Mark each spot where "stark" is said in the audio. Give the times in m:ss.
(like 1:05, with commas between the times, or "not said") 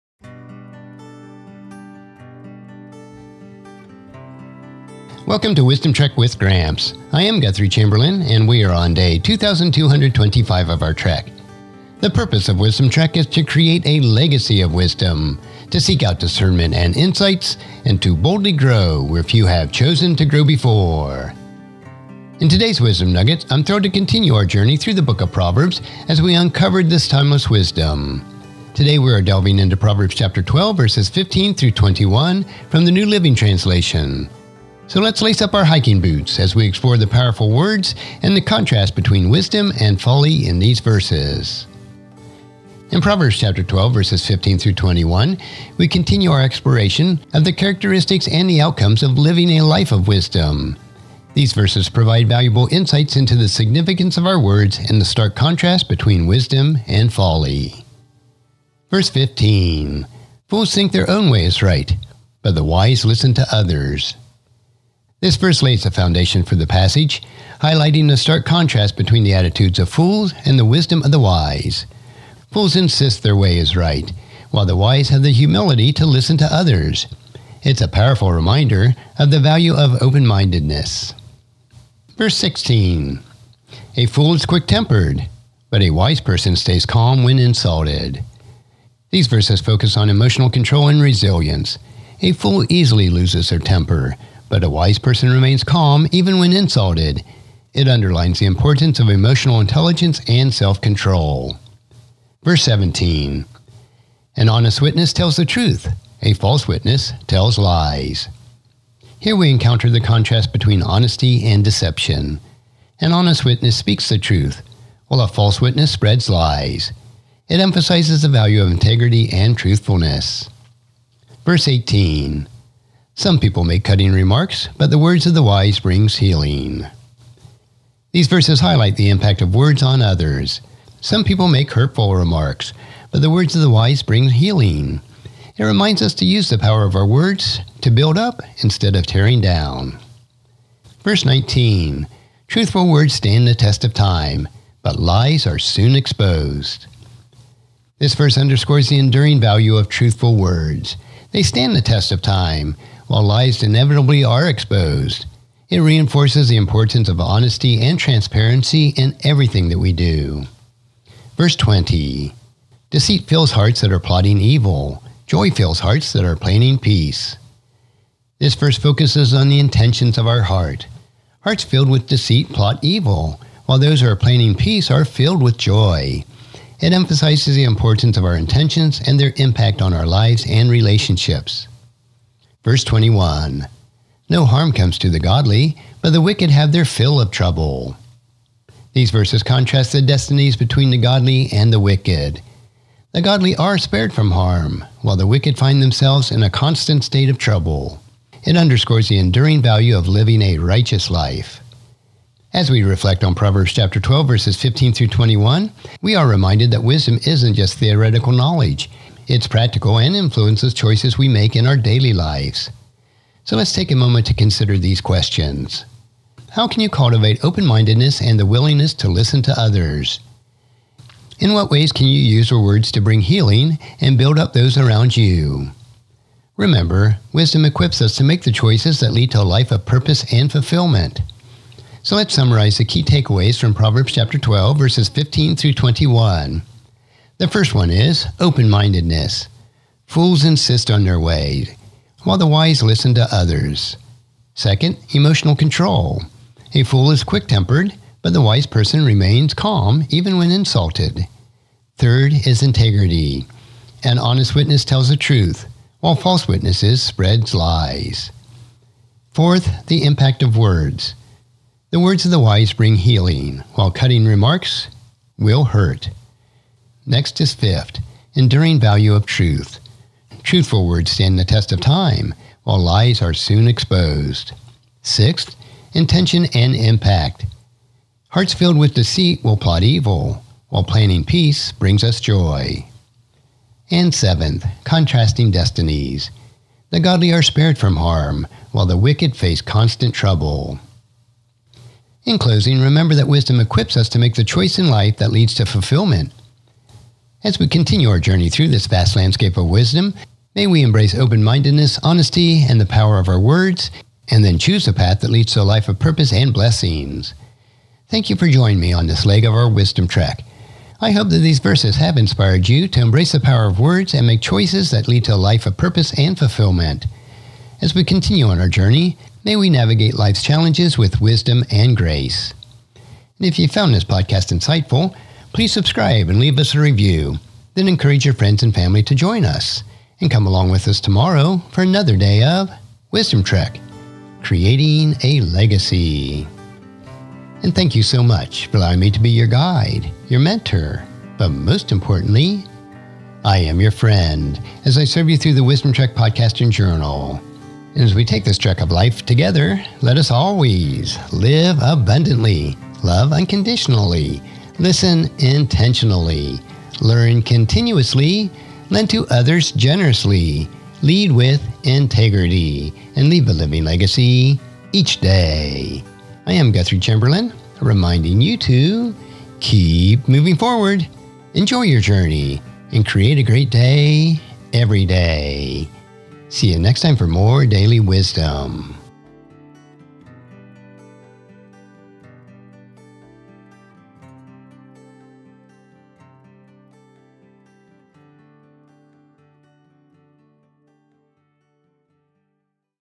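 0:55, 1:08.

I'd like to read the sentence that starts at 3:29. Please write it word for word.
It's practical and influences choices we make in our daily lives.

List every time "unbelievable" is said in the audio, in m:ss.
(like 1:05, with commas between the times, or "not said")
not said.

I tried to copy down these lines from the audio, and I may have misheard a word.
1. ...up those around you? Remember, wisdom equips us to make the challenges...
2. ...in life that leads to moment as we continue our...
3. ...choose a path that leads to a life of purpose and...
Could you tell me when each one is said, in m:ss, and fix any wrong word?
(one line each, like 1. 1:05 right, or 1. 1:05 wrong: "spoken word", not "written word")
1. 3:44 wrong: "choices", not "challenges"
2. 4:54 wrong: "fulfillment", not "moment"
3. 5:04 right.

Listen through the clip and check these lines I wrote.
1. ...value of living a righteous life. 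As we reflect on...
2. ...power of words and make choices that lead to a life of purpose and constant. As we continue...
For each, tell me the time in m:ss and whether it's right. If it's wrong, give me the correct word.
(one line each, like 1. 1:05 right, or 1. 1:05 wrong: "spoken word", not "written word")
1. 3:19 right
2. 5:13 wrong: "fulfillment", not "constant".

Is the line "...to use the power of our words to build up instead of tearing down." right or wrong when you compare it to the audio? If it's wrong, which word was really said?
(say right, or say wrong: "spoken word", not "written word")
right.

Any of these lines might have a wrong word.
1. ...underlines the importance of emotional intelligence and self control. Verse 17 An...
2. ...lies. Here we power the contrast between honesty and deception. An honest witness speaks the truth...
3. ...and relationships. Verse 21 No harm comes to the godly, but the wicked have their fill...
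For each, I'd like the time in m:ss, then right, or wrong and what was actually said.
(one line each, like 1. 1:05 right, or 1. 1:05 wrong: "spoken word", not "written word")
1. 1:37 right
2. 1:47 wrong: "encounter", not "power"
3. 3:00 right.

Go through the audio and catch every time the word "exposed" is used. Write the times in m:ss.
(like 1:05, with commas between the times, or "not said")
2:25, 2:34, 4:33.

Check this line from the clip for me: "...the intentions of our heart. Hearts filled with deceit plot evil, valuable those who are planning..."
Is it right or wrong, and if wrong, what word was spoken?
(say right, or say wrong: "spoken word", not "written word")
wrong: "while", not "valuable".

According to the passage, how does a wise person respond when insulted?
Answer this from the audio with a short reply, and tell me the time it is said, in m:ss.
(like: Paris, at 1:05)
stays calm, at 1:26.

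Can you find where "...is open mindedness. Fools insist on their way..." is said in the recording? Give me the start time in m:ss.
3:57.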